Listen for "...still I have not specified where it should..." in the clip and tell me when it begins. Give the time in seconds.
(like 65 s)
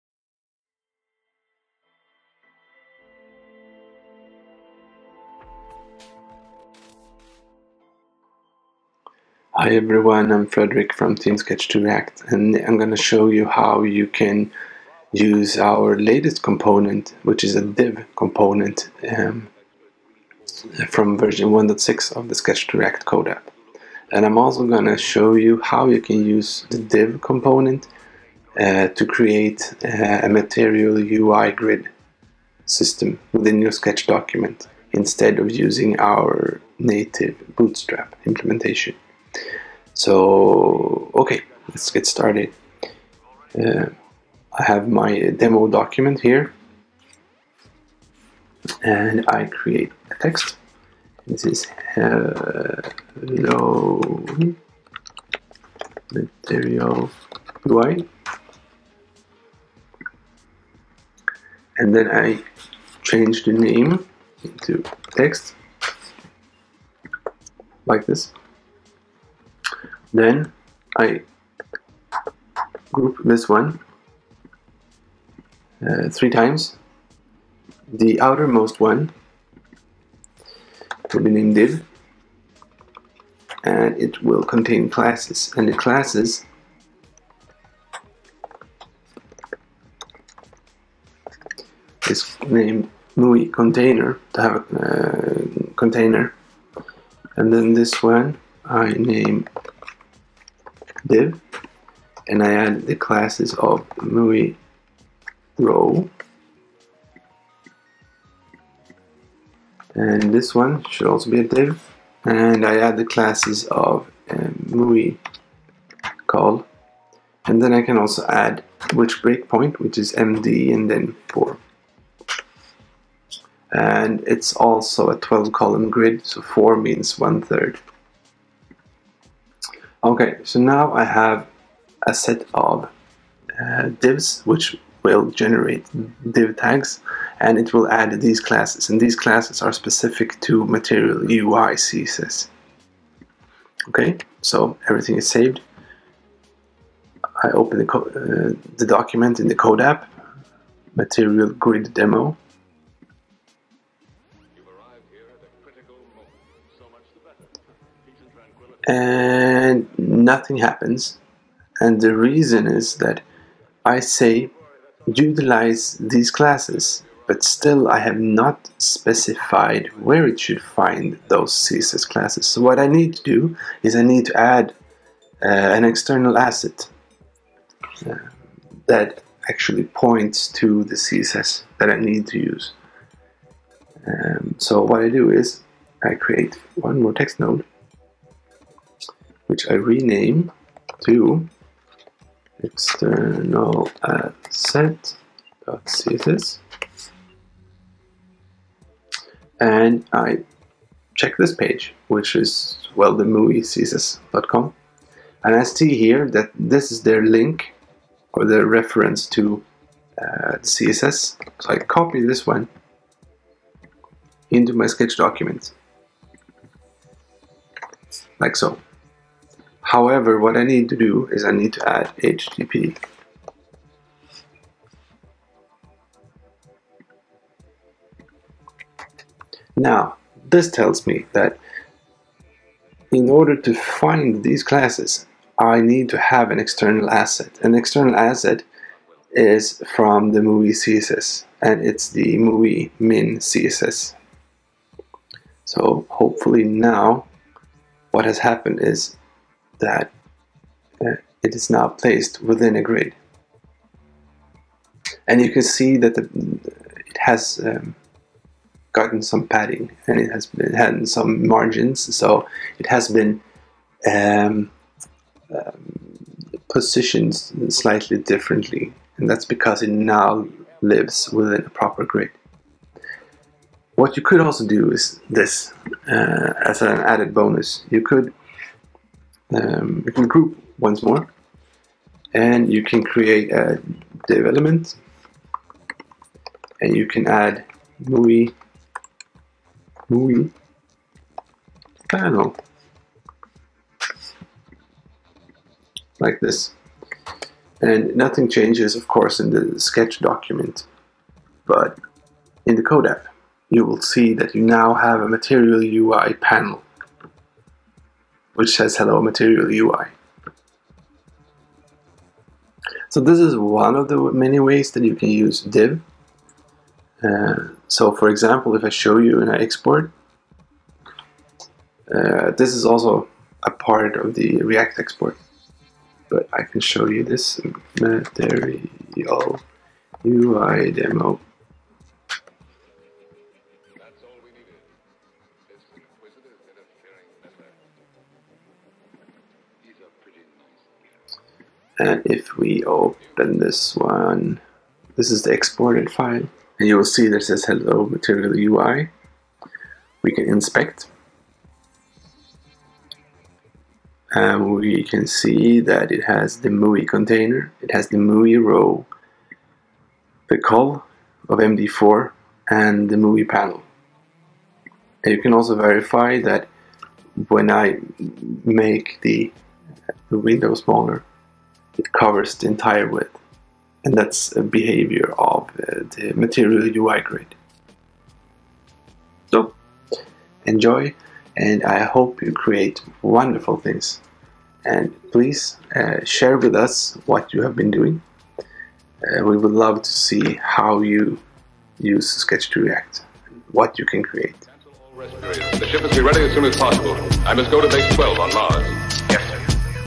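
167 s.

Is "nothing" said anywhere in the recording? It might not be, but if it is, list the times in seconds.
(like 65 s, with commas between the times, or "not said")
159 s, 298 s.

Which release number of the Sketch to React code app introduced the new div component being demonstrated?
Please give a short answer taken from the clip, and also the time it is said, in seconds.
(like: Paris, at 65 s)
1.6, at 21 s.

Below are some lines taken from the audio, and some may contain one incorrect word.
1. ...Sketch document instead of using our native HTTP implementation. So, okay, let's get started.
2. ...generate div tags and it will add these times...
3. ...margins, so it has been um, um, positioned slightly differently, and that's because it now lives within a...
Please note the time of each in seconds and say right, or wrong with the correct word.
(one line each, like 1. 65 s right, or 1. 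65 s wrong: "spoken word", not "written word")
1. 33 s wrong: "Bootstrap", not "HTTP"
2. 135 s wrong: "classes", not "times"
3. 261 s right.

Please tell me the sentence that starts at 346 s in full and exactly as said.
And you will see that says hello material UI.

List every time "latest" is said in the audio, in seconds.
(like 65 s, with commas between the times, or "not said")
15 s.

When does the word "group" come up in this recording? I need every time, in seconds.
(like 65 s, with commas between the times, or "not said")
72 s, 280 s.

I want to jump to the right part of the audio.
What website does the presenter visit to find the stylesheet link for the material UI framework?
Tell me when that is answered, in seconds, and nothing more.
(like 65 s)
203 s.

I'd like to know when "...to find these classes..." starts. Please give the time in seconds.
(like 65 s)
233 s.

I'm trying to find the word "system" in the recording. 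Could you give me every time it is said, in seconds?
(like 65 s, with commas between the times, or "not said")
32 s.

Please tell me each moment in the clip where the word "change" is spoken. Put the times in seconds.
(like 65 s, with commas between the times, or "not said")
63 s, 298 s.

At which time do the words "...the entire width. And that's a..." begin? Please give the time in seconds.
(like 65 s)
372 s.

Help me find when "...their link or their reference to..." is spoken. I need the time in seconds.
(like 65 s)
207 s.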